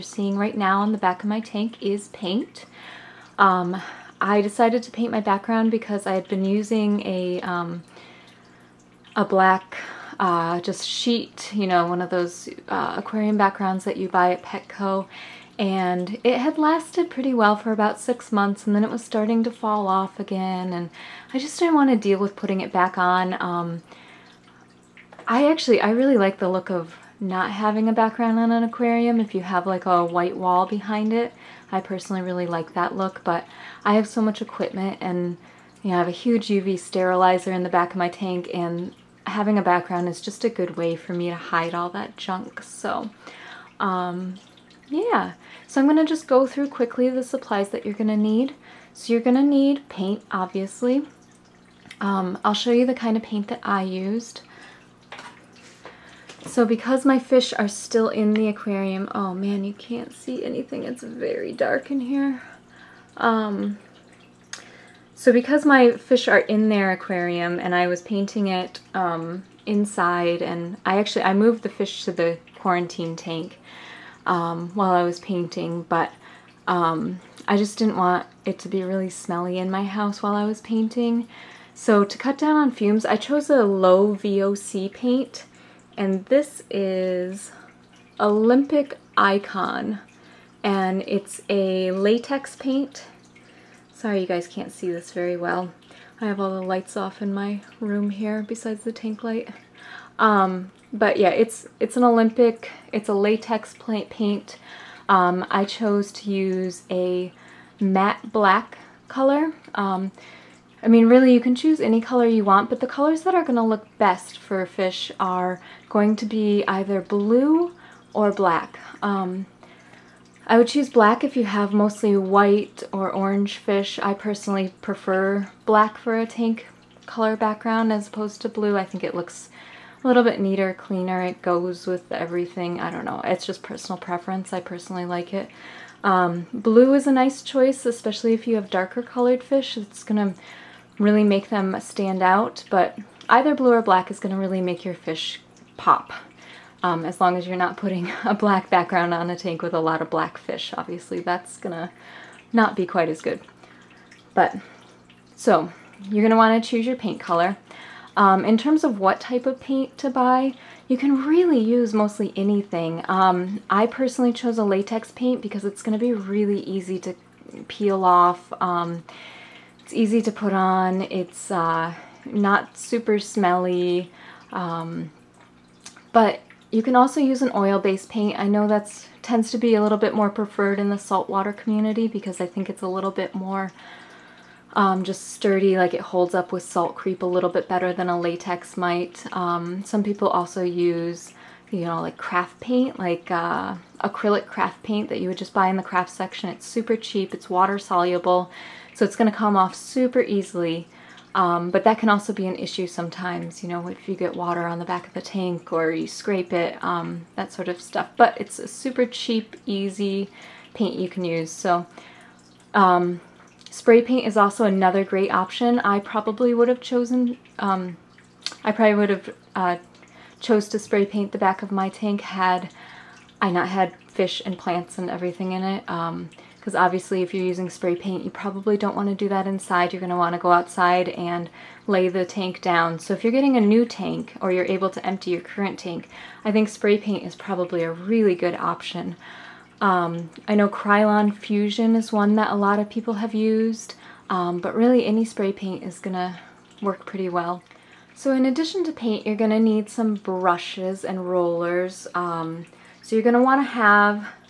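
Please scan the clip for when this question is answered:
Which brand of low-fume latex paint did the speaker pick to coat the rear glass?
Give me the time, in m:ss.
1:28.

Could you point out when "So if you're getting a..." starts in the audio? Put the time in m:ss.
3:52.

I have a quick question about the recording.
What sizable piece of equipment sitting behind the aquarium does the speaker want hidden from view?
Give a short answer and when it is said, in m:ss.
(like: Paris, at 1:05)
UV sterilizer, at 0:36.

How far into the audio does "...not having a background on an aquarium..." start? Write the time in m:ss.
0:27.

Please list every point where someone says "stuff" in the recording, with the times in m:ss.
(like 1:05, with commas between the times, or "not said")
3:27.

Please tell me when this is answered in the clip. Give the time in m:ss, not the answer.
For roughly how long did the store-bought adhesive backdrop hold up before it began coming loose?
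0:17.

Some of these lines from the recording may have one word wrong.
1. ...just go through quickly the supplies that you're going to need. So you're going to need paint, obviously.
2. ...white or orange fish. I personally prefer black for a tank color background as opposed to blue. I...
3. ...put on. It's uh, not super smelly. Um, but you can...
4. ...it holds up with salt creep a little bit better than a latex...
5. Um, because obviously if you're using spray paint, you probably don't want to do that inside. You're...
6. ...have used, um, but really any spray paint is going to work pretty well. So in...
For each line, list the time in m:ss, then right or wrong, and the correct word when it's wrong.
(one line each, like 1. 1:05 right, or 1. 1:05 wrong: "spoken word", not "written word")
1. 0:46 right
2. 2:02 right
3. 2:50 right
4. 3:05 right
5. 3:45 right
6. 4:03 right.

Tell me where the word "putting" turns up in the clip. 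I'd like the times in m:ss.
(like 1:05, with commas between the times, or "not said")
0:22, 2:27.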